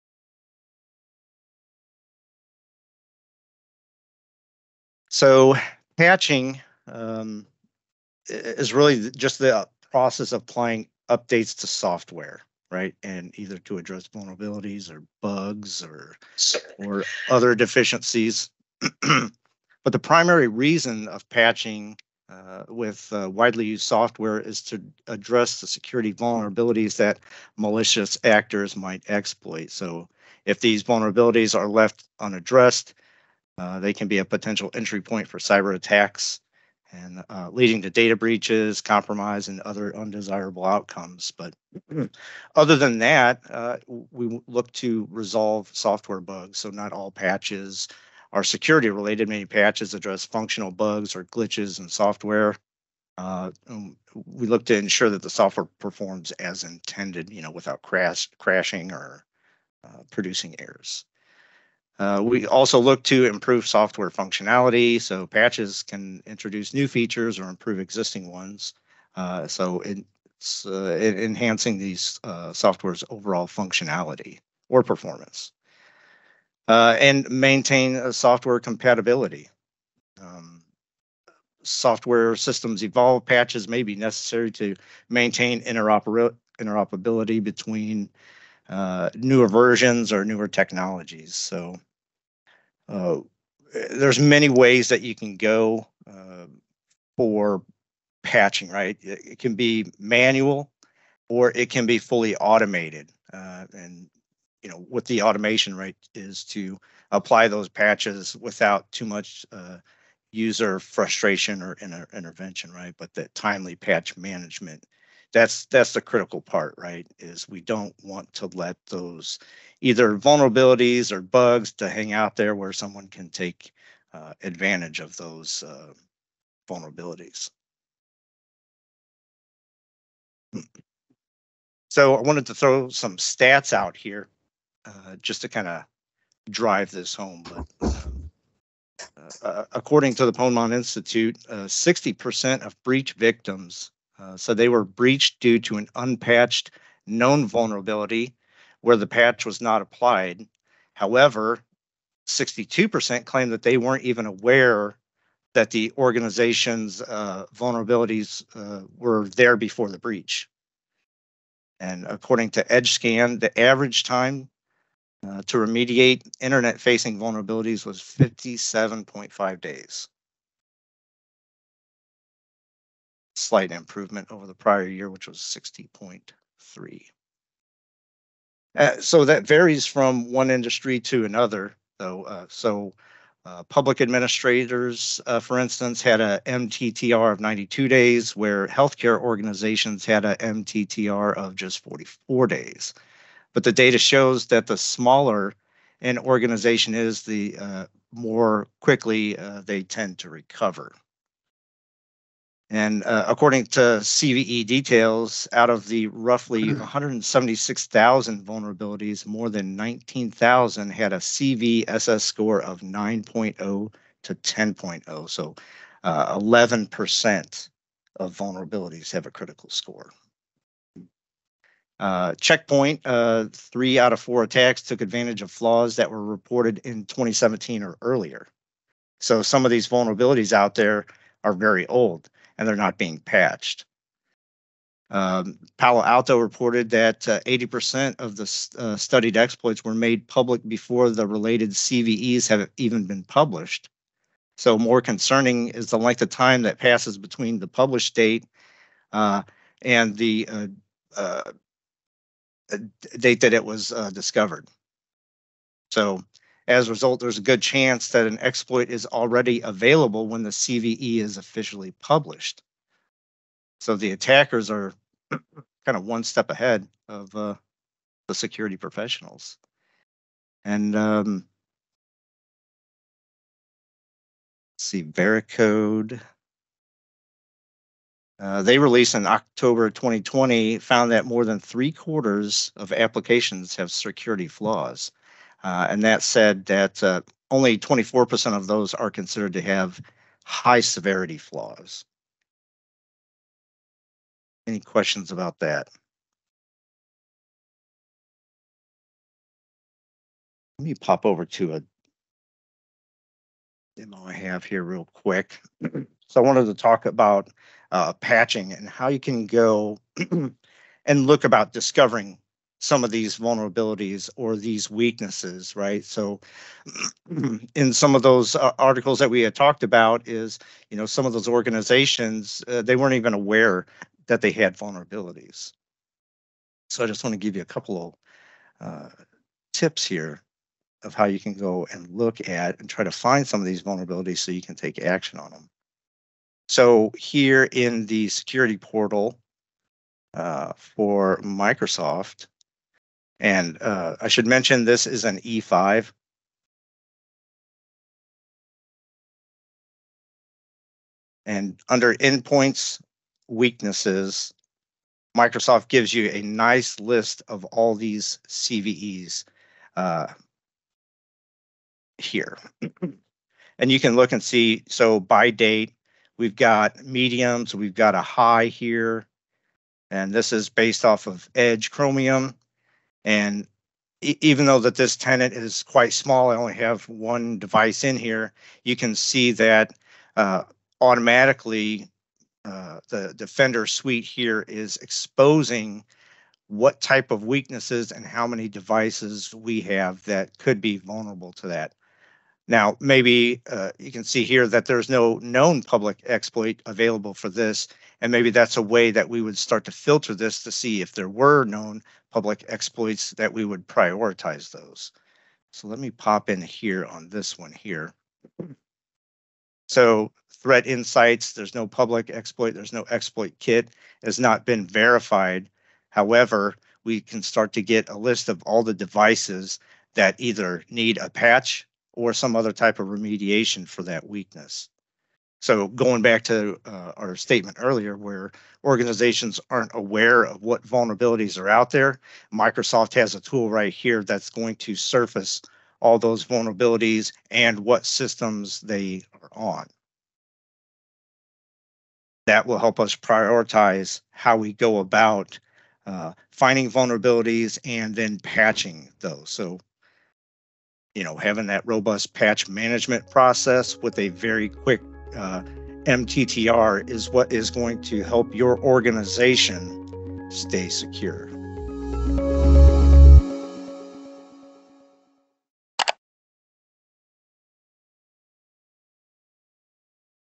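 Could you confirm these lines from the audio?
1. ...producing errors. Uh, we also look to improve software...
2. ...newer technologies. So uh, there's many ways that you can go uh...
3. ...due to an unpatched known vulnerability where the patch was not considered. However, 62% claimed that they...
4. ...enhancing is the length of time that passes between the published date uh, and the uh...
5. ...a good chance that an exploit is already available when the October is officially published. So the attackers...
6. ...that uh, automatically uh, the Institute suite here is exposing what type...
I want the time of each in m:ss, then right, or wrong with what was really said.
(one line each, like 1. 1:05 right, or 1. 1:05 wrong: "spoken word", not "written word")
1. 1:00 right
2. 1:30 right
3. 2:25 wrong: "applied", not "considered"
4. 4:05 wrong: "concerning", not "enhancing"
5. 4:17 wrong: "CVE", not "October"
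6. 6:19 wrong: "Defender", not "Institute".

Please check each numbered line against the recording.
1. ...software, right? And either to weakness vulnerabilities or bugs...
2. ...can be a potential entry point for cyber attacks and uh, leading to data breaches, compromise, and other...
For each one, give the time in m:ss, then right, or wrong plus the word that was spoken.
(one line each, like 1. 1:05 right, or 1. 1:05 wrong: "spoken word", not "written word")
1. 0:11 wrong: "address", not "weakness"
2. 0:33 right.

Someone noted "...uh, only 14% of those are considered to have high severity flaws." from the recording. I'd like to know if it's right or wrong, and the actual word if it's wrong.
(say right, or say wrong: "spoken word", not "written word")
wrong: "24", not "14".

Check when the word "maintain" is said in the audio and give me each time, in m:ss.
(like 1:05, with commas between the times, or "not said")
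1:17, 1:25.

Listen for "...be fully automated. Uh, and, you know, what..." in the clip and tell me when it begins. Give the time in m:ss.
1:41.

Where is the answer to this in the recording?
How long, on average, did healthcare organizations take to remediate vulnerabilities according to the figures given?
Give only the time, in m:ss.
3:11.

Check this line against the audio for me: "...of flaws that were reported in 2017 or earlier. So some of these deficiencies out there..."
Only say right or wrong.
wrong.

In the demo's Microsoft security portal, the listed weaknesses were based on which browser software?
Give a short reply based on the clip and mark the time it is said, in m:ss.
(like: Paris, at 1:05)
Edge Chromium, at 6:11.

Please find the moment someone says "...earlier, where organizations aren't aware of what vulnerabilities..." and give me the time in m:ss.
7:07.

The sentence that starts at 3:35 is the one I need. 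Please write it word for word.
So 11% uh, of vulnerabilities have a critical score.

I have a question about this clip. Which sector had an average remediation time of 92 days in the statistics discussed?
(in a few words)
public administrators.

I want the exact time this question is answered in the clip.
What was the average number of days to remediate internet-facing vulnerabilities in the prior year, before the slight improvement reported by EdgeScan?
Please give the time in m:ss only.
2:55.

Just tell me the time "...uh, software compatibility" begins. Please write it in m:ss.
1:17.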